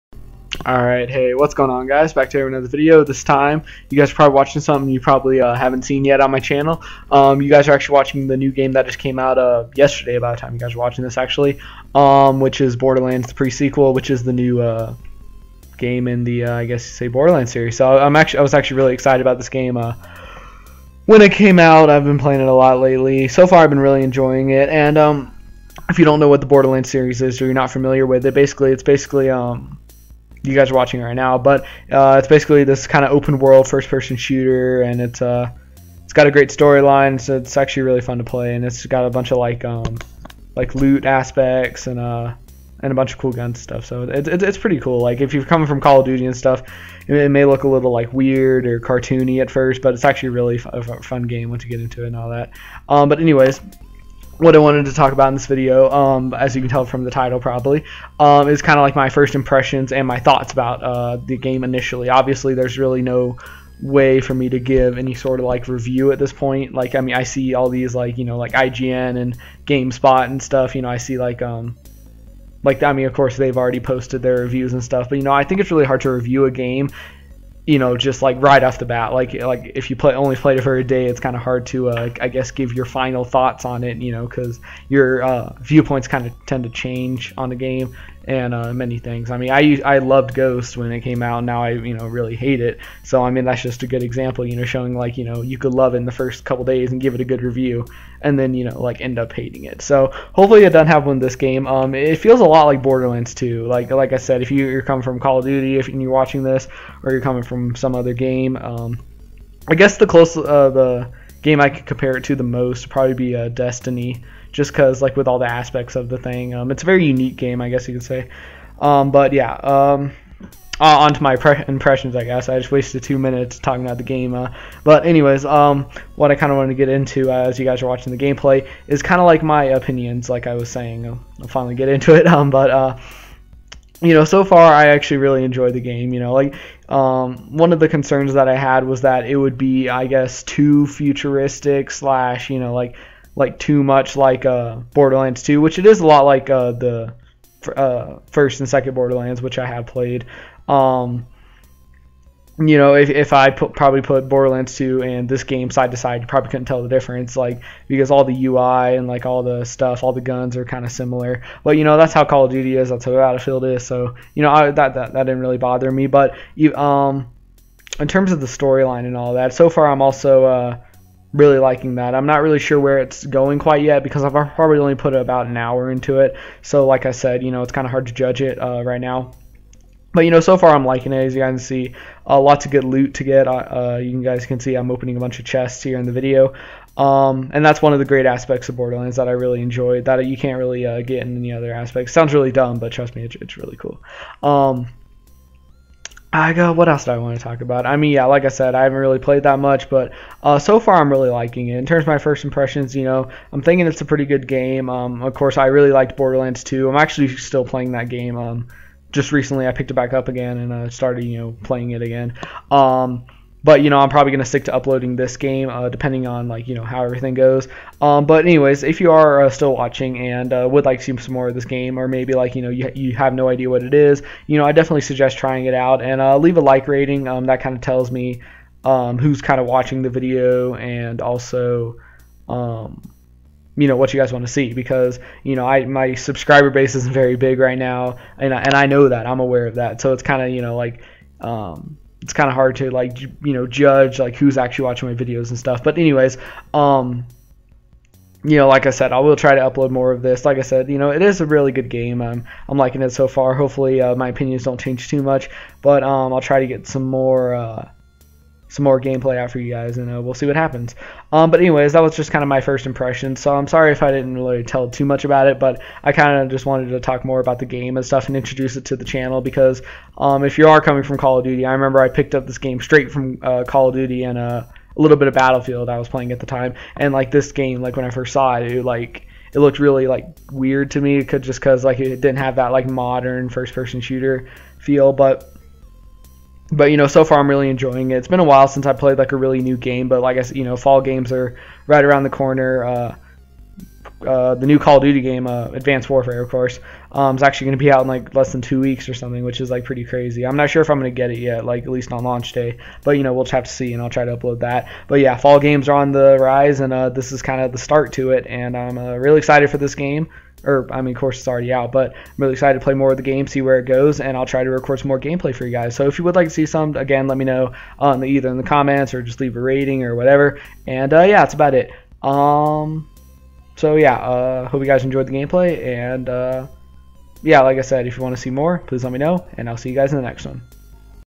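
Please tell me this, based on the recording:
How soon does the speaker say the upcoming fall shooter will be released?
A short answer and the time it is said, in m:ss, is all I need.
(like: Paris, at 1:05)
less than two weeks, at 4:58.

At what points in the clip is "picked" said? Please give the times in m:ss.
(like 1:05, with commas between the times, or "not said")
3:29, 4:32.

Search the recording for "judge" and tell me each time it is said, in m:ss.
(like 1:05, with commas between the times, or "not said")
2:58, 4:03.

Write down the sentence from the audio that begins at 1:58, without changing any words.
Um, but yeah, um, uh, on to my pre- impressions, I guess.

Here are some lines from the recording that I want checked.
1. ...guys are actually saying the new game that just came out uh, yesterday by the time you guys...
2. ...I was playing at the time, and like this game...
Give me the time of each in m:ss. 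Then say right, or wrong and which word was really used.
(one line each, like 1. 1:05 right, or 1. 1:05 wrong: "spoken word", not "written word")
1. 0:07 wrong: "watching", not "saying"
2. 4:35 right.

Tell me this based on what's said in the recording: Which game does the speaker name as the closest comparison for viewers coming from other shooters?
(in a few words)
Destiny.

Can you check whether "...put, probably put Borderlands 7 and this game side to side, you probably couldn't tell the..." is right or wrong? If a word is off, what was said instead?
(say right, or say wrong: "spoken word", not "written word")
wrong: "2", not "7".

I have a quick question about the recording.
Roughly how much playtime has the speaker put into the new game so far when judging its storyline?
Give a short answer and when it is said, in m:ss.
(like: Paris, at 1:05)
about an hour, at 2:55.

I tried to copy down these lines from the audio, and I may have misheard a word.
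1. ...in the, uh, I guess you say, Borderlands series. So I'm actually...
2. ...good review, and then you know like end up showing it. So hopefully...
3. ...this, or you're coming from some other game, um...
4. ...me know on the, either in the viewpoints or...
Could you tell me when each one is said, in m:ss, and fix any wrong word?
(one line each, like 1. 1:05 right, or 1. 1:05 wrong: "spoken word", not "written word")
1. 0:16 right
2. 1:37 wrong: "hating", not "showing"
3. 1:46 right
4. 5:17 wrong: "comments", not "viewpoints".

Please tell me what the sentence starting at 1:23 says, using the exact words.
You know, because your uh, viewpoints kind of tend to change on the game and uh, many things.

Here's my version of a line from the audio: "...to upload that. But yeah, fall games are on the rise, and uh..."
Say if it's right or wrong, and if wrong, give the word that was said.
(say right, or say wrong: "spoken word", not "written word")
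right.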